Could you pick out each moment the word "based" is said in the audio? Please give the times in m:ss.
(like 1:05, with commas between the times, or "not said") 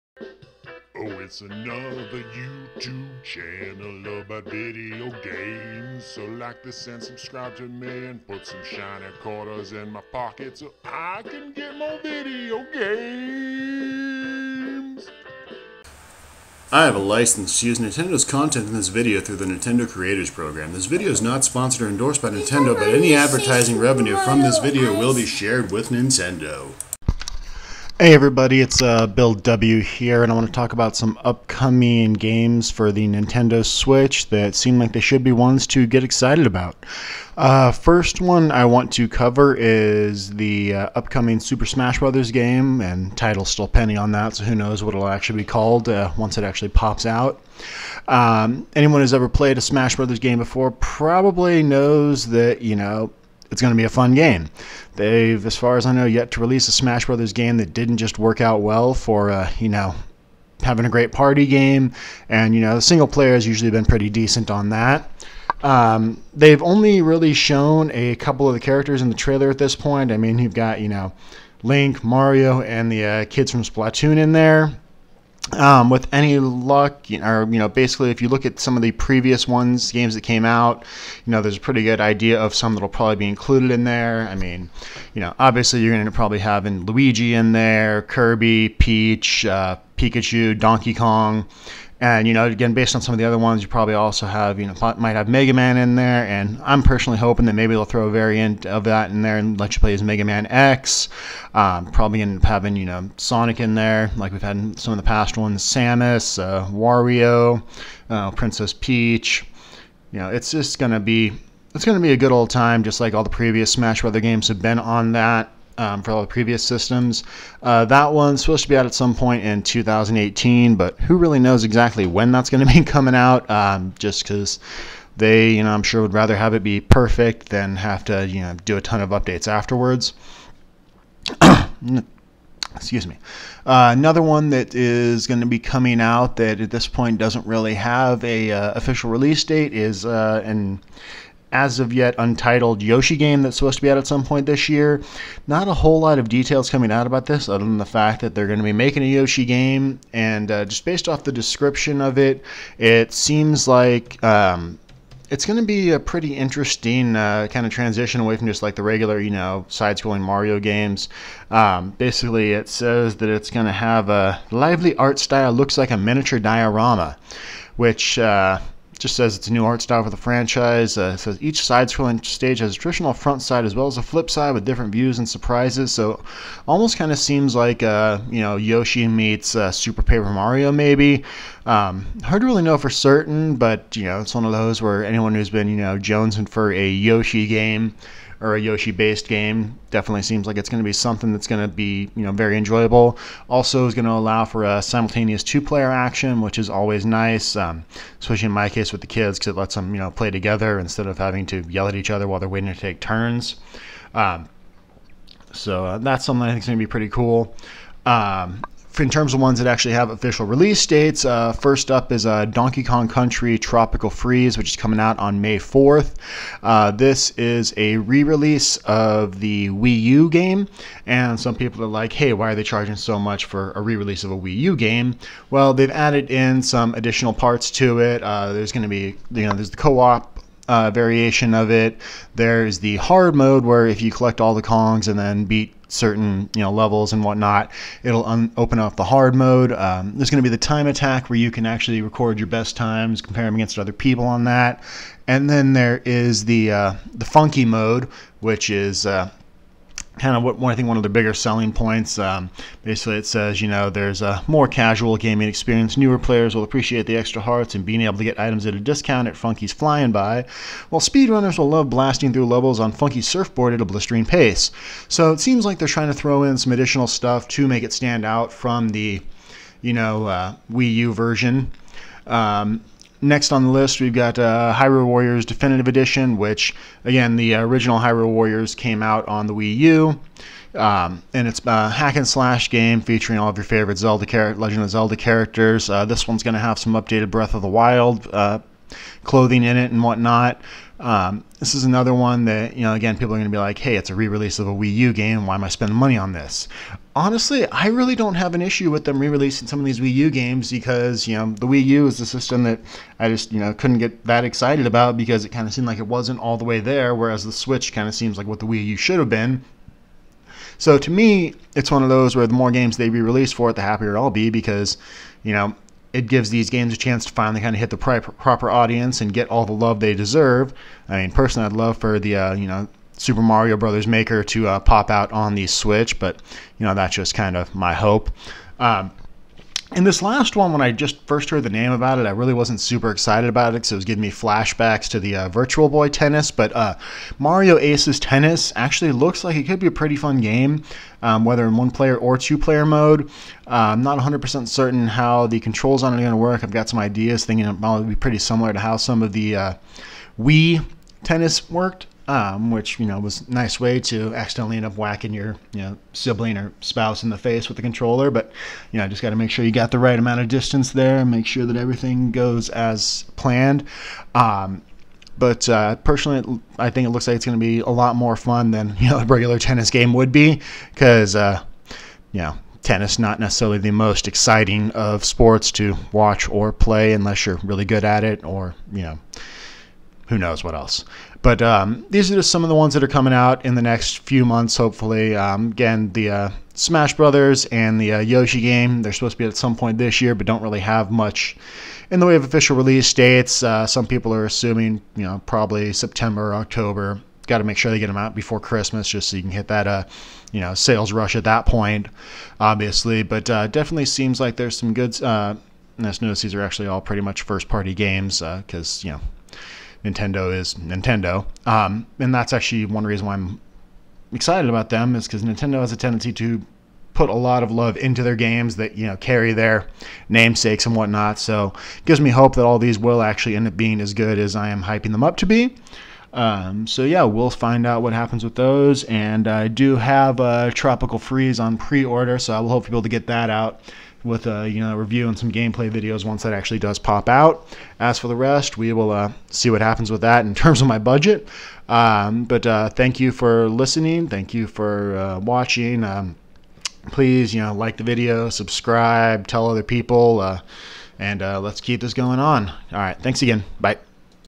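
1:32, 2:30, 3:08.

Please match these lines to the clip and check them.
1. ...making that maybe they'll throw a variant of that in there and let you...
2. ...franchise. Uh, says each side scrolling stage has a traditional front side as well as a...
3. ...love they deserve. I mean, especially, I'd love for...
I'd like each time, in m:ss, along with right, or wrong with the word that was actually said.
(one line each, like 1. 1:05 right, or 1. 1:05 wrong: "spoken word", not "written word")
1. 1:37 wrong: "hoping", not "making"
2. 2:50 right
3. 5:19 wrong: "personally", not "especially".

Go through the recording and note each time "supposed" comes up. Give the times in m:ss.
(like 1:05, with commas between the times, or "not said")
1:58, 2:23, 6:29.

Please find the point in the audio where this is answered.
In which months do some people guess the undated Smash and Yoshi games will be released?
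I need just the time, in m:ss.
6:35.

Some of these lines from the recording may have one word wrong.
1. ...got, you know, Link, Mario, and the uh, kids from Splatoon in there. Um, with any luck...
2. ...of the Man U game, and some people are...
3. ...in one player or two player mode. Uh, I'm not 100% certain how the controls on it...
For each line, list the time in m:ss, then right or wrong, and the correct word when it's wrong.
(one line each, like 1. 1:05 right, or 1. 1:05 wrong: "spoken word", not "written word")
1. 1:10 right
2. 3:38 wrong: "Wii", not "Man"
3. 5:41 right.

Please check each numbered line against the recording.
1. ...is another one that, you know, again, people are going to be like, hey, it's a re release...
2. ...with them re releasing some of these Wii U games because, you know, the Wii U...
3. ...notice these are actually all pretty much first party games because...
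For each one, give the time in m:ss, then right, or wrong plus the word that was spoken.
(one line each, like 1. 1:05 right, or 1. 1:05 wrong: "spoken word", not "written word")
1. 4:51 right
2. 4:58 right
3. 6:46 right.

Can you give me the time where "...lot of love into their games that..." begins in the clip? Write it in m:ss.
6:57.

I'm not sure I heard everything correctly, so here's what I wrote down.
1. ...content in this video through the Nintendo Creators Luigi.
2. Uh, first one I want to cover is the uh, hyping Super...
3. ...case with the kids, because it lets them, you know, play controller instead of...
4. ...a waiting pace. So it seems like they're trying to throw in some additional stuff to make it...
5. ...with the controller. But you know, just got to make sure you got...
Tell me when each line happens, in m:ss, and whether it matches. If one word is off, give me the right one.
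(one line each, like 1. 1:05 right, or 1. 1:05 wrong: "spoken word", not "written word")
1. 0:18 wrong: "Program", not "Luigi"
2. 0:37 wrong: "upcoming", not "hyping"
3. 3:18 wrong: "together", not "controller"
4. 4:23 wrong: "blistering", not "waiting"
5. 5:57 right.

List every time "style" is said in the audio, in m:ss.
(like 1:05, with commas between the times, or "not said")
2:45, 2:49.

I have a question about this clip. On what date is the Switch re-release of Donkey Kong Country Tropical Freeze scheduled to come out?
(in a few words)
May 4th.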